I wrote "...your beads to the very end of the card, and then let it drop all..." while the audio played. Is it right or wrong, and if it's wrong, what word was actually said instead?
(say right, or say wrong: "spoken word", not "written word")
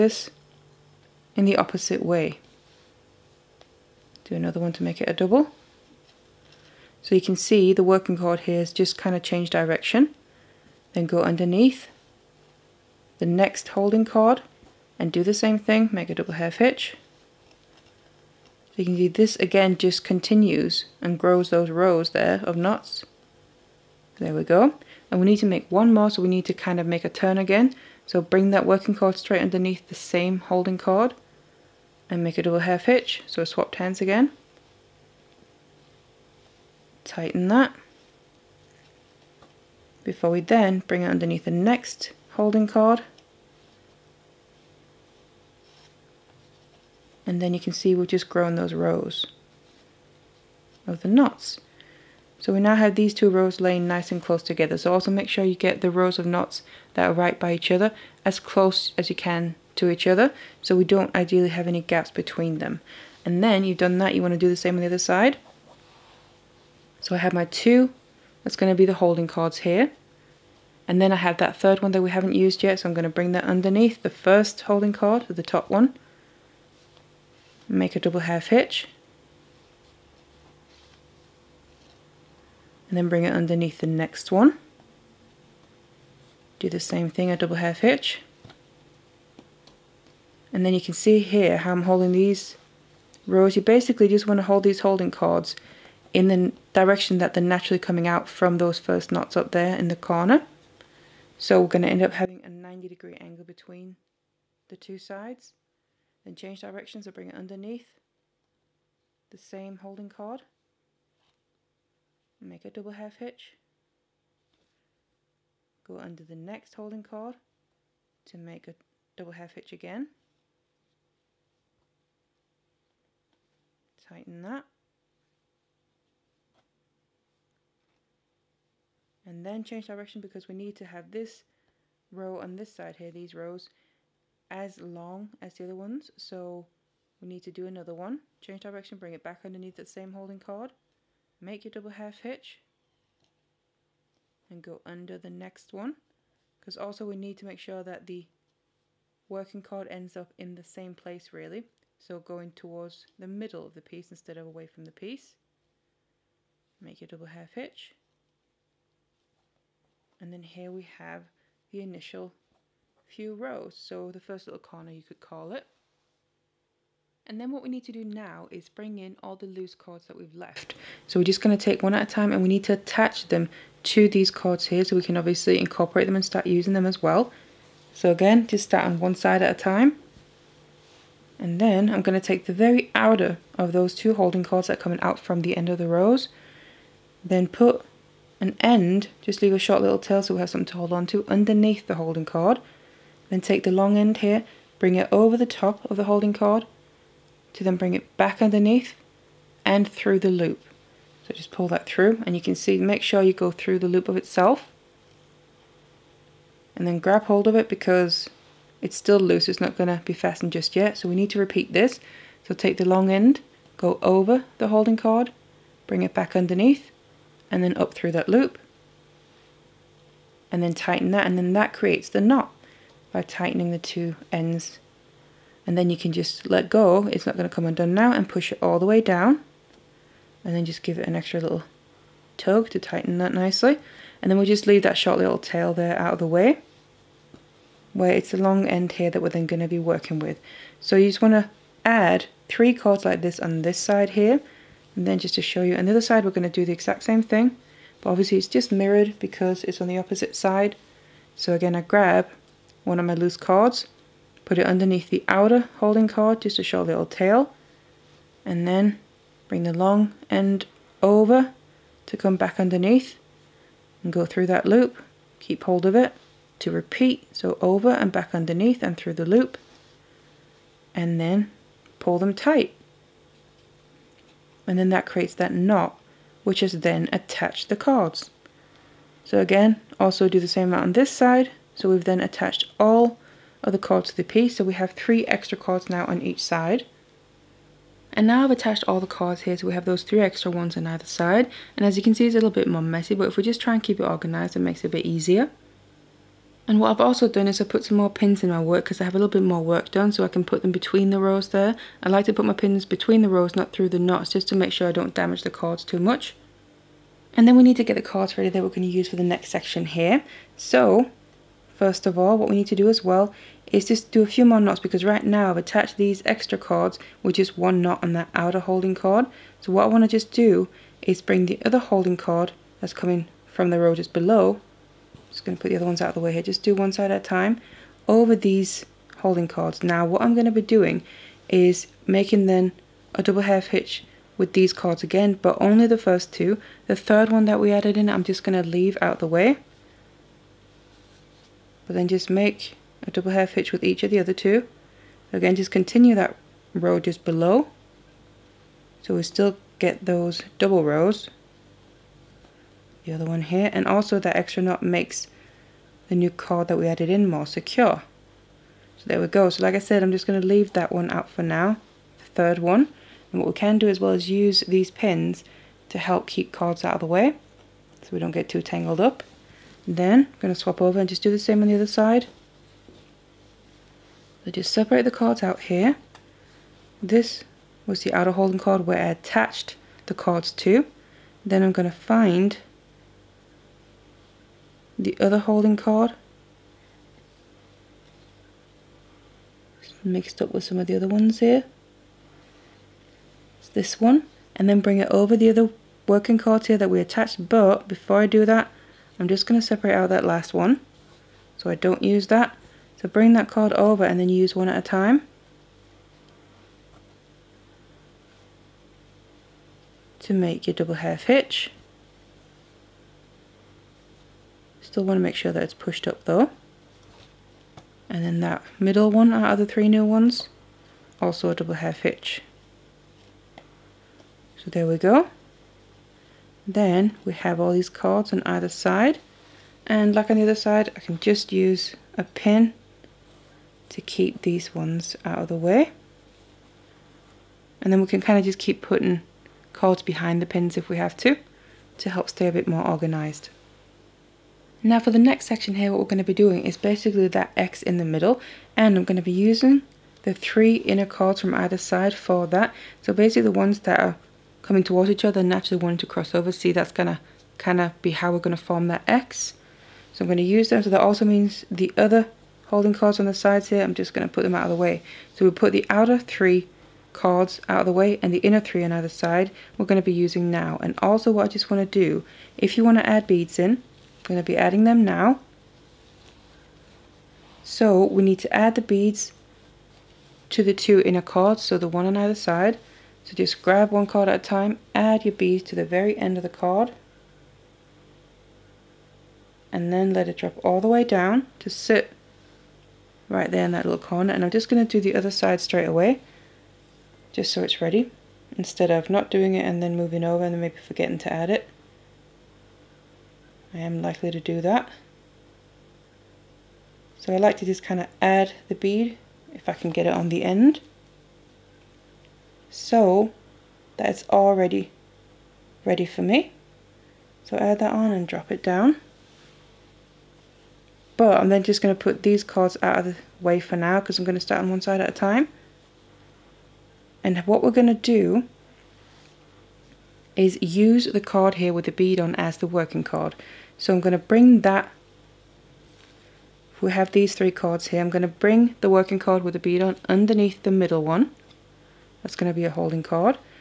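right.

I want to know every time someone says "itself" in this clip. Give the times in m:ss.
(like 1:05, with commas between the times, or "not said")
3:24.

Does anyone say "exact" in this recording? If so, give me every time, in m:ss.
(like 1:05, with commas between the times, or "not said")
4:06.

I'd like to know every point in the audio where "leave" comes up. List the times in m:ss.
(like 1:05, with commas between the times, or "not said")
3:09, 3:54, 5:38, 6:00.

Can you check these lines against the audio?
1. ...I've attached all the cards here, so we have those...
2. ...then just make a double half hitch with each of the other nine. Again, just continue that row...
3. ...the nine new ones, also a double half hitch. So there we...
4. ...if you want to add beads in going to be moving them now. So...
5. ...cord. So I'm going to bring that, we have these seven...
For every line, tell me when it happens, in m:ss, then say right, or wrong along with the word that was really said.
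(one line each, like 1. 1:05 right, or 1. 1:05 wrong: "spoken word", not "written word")
1. 4:48 right
2. 5:41 wrong: "two", not "nine"
3. 6:59 wrong: "three", not "nine"
4. 7:52 wrong: "adding", not "moving"
5. 8:53 wrong: "three", not "seven".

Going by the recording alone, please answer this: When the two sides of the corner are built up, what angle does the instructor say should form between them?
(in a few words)
90 degree angle.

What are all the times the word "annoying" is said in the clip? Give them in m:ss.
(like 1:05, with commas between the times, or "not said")
not said.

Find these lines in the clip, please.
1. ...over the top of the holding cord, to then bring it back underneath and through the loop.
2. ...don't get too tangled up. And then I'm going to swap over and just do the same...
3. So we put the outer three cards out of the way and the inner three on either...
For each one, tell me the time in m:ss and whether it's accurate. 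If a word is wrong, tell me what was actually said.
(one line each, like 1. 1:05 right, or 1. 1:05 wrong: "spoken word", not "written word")
1. 3:15 right
2. 6:08 right
3. 7:45 right.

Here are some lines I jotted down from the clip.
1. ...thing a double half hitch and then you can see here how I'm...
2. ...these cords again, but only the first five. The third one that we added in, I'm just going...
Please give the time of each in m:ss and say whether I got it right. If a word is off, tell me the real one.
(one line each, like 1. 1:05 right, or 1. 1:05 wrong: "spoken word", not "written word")
1. 1:27 right
2. 5:34 wrong: "two", not "five".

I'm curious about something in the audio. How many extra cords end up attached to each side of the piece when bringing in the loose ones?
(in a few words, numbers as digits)
3.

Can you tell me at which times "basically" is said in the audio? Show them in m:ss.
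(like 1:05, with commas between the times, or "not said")
1:33, 7:26, 7:33.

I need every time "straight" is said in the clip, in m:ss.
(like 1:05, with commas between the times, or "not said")
0:29, 8:15.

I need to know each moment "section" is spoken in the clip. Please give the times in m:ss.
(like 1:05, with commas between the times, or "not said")
5:09, 7:25.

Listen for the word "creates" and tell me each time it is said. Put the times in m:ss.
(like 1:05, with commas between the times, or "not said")
3:41, 4:35.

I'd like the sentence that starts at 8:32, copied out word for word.
So that it's already ready for me.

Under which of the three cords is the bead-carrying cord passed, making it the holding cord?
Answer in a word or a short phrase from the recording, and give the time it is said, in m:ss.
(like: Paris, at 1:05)
the middle one, at 9:00.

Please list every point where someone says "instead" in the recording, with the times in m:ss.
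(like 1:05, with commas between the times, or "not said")
2:34, 8:18.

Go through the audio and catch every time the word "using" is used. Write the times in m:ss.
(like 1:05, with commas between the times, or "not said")
2:56, 7:29, 7:50.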